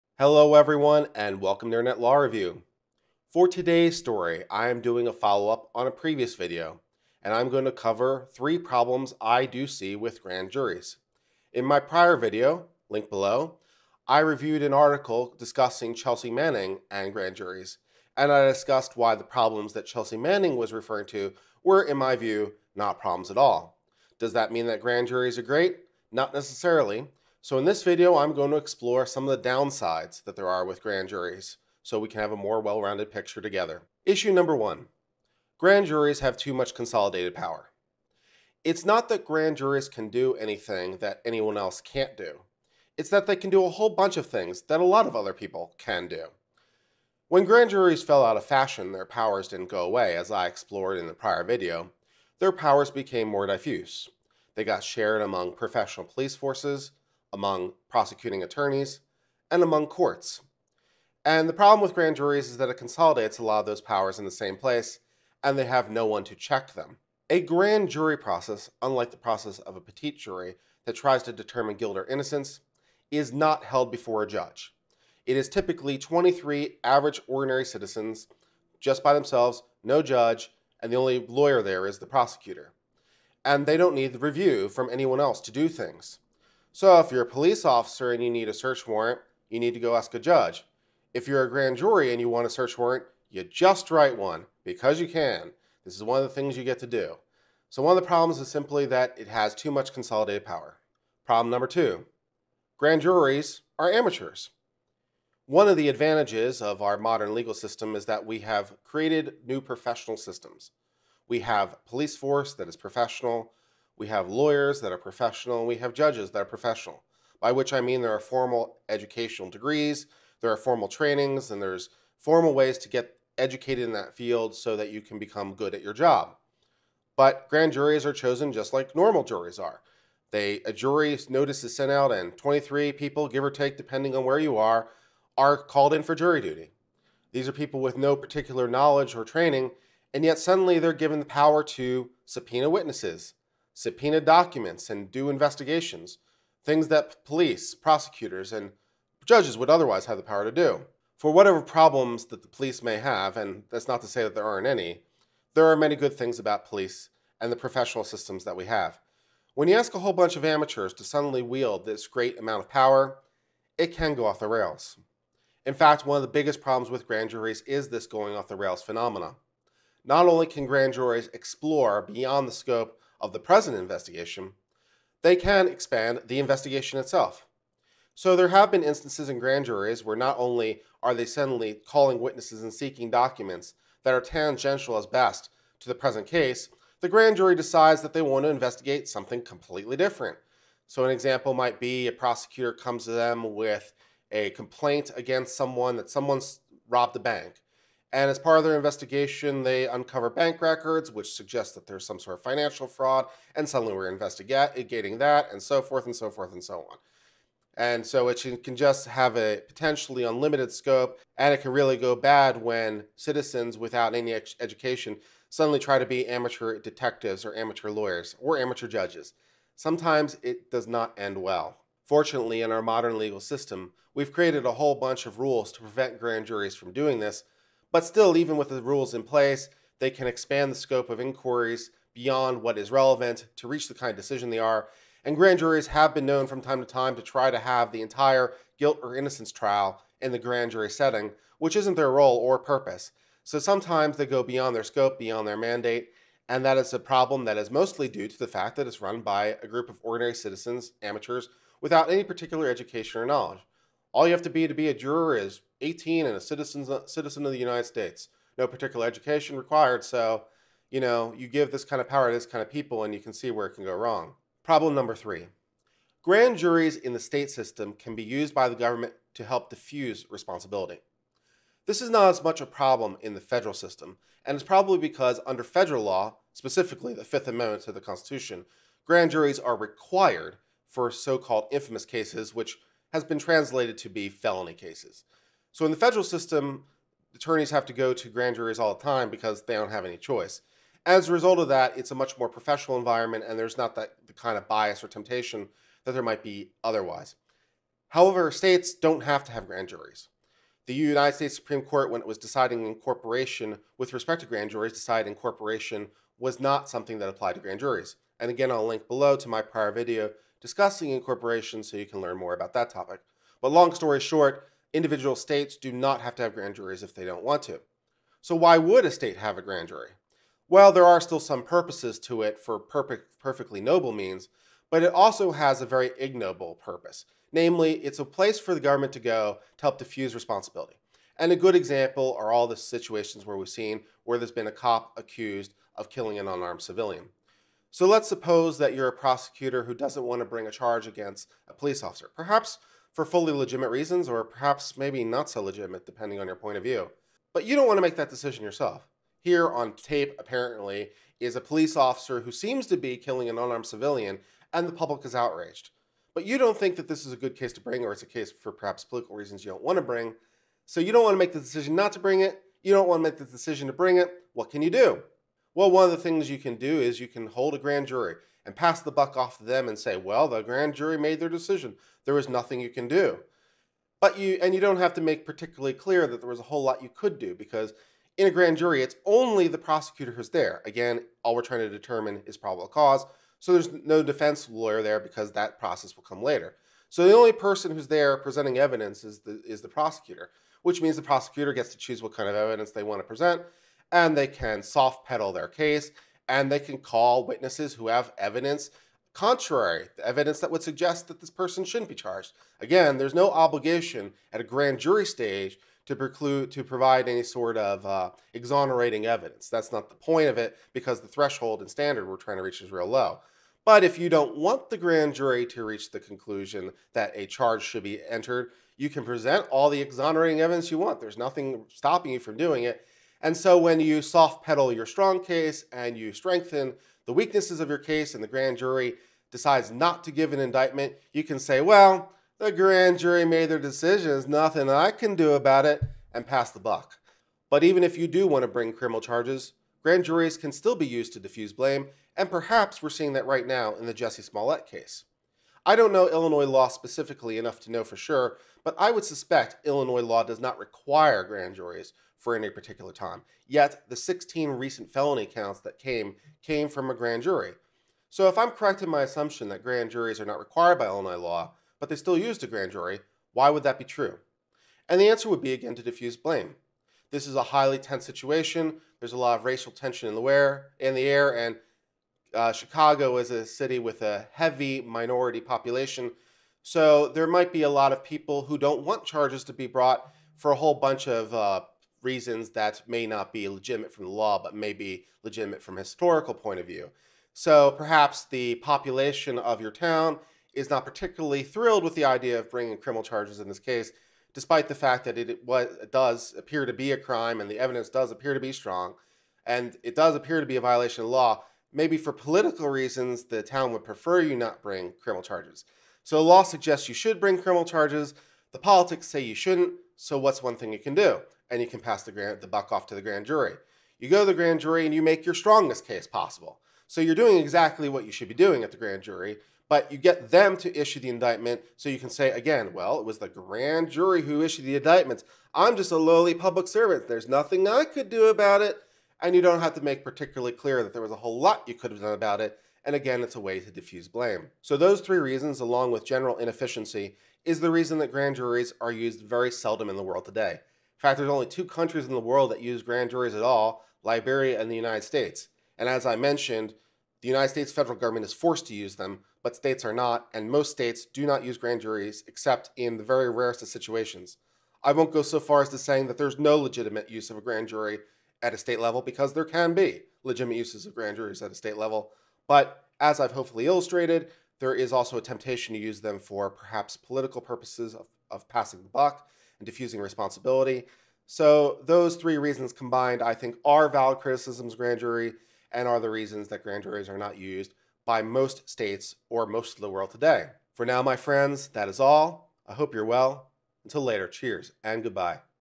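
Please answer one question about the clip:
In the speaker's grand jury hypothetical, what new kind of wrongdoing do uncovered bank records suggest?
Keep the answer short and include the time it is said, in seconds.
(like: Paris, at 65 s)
Financial fraud, at 202 s.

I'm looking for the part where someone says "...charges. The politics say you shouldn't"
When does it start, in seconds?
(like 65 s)
507 s.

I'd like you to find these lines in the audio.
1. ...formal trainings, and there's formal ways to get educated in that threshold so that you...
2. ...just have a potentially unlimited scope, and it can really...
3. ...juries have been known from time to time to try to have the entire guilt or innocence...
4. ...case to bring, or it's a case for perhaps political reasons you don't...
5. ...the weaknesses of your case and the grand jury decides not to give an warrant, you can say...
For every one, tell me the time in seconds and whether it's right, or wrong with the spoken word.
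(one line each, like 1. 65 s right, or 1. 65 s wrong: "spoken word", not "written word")
1. 120 s wrong: "field", not "threshold"
2. 208 s right
3. 235 s right
4. 357 s right
5. 427 s wrong: "indictment", not "warrant".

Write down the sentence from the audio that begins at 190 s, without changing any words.
So an example might be a prosecutor comes to them with a complaint against someone that someone's robbed a bank.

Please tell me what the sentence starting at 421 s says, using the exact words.
There's nothing stopping you from doing it.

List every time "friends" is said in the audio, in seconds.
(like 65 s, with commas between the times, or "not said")
581 s.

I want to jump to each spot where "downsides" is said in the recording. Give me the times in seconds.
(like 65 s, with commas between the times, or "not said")
29 s.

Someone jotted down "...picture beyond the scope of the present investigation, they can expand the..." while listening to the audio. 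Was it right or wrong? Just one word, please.
wrong.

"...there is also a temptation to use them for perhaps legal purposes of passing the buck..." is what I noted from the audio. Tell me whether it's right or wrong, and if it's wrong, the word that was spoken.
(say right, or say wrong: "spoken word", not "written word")
wrong: "political", not "legal".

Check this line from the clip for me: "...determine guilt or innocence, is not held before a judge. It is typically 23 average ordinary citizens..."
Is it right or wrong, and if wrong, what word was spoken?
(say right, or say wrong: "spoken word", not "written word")
right.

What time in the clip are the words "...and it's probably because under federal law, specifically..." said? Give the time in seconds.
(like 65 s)
274 s.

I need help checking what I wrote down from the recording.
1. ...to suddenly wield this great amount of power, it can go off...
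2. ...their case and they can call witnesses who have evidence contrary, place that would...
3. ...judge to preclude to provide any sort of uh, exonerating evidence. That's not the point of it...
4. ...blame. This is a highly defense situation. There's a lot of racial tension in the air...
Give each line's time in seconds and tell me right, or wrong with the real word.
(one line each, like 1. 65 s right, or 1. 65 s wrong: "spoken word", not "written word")
1. 160 s right
2. 395 s wrong: "evidence", not "place"
3. 405 s wrong: "stage", not "judge"
4. 466 s wrong: "tense", not "defense".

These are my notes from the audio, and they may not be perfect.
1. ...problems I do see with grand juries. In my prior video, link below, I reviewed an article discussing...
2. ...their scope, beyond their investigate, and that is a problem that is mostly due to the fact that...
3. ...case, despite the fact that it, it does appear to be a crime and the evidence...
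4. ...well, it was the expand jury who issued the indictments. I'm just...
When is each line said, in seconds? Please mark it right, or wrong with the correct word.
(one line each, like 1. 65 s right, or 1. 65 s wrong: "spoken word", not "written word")
1. 8 s right
2. 244 s wrong: "mandate", not "investigate"
3. 493 s right
4. 522 s wrong: "grand", not "expand".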